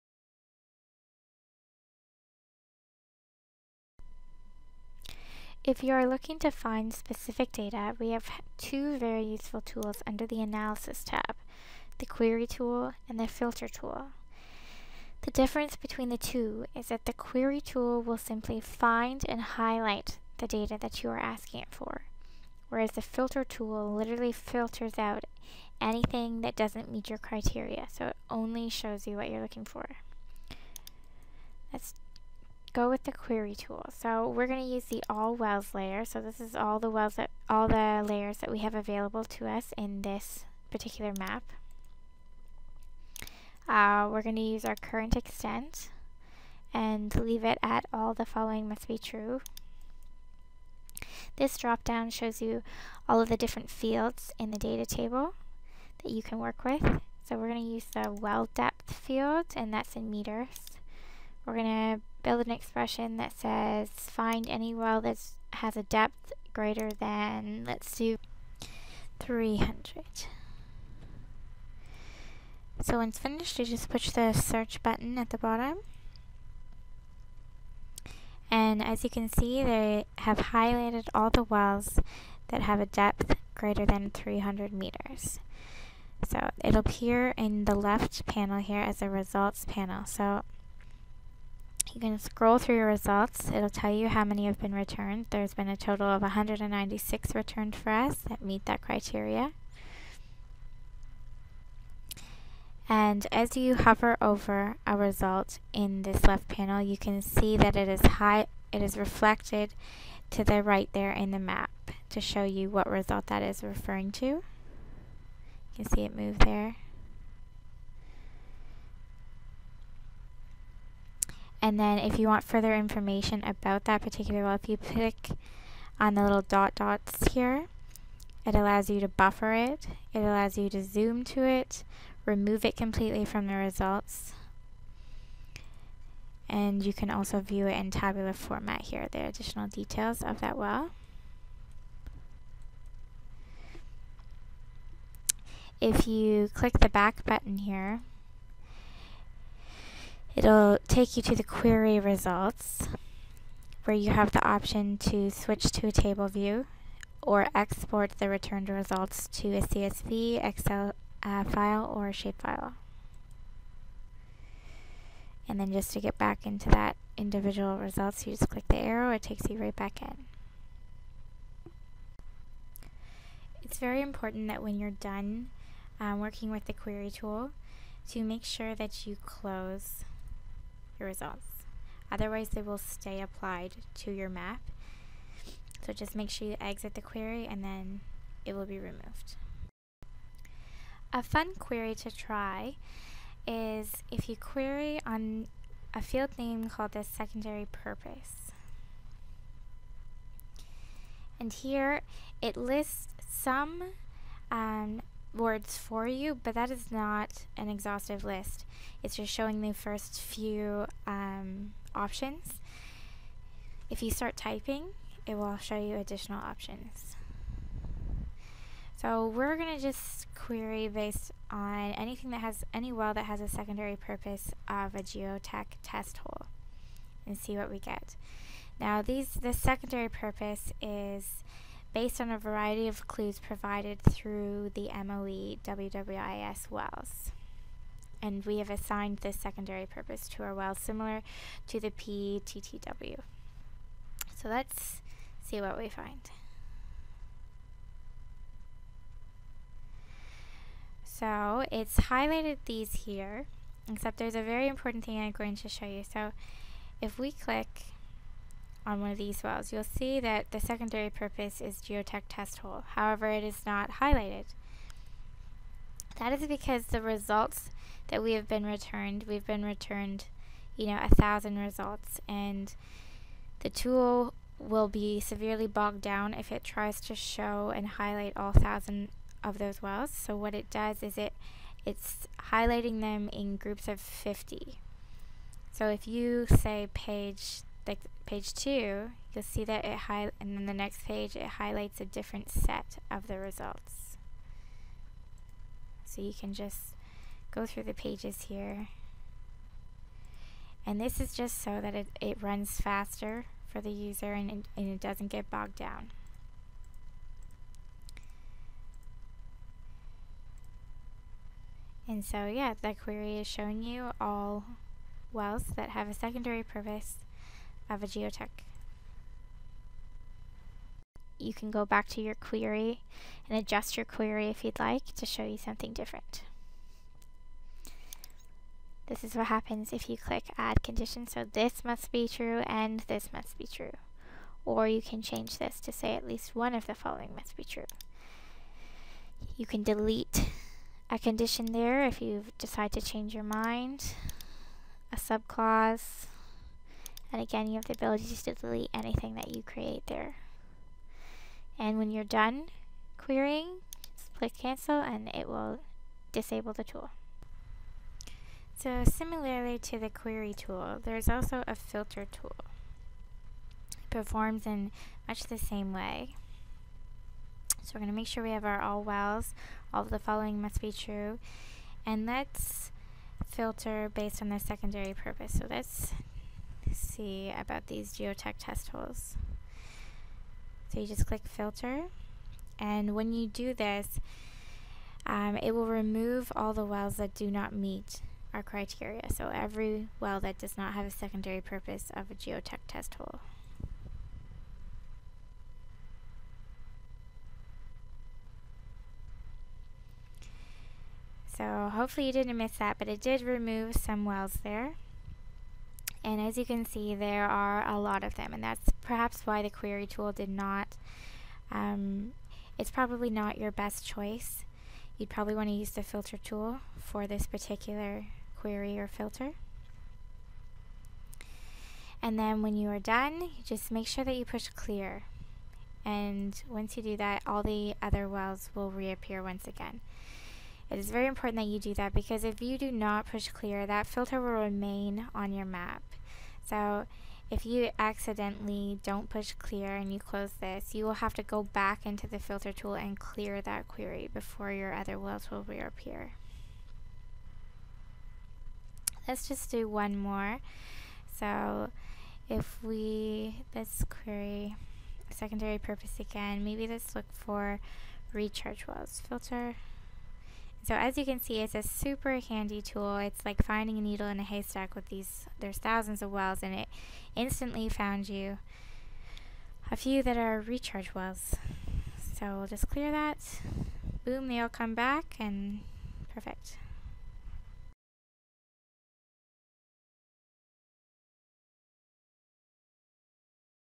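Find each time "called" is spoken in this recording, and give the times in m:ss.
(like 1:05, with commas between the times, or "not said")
3:16.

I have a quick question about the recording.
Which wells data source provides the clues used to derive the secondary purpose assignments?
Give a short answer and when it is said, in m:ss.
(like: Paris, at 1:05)
MOE WWIS, at 3:55.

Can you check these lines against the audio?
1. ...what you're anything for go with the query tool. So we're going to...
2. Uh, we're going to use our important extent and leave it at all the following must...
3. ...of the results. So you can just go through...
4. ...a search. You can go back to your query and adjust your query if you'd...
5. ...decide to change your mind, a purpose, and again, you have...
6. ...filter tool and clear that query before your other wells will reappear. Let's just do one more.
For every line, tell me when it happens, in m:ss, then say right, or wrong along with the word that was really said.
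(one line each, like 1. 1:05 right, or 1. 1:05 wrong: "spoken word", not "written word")
1. 0:29 wrong: "looking", not "anything"
2. 0:43 wrong: "current", not "important"
3. 4:53 right
4. 5:18 wrong: "geotech", not "search"
5. 5:42 wrong: "subclause", not "purpose"
6. 7:22 right.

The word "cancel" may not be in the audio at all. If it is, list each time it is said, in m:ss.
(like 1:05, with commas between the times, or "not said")
5:54.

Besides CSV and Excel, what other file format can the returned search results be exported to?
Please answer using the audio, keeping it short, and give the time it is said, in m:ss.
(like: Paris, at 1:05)
shapefile, at 2:42.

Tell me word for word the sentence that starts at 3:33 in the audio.
If you start typing, it will show you additional options.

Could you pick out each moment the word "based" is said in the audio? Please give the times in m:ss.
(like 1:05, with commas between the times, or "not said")
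3:40, 3:51, 6:14.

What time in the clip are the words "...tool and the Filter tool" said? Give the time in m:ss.
0:12.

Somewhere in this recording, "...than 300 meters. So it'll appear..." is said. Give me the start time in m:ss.
1:23.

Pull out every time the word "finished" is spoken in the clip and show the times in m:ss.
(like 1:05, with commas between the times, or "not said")
1:13.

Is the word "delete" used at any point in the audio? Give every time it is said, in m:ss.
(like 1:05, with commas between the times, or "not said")
5:39, 5:48.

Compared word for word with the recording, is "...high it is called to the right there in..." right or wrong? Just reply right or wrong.
wrong.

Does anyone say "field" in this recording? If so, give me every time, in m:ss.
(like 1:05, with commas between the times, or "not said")
0:53, 0:58, 3:16.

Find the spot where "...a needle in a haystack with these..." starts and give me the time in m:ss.
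7:43.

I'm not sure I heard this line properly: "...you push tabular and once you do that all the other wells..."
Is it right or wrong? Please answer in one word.
wrong.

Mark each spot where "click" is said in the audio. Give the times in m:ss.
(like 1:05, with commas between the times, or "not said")
2:04, 2:26, 2:48, 4:17, 5:30, 5:54, 6:21.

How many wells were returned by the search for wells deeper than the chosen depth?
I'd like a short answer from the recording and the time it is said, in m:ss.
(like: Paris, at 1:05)
196, at 1:36.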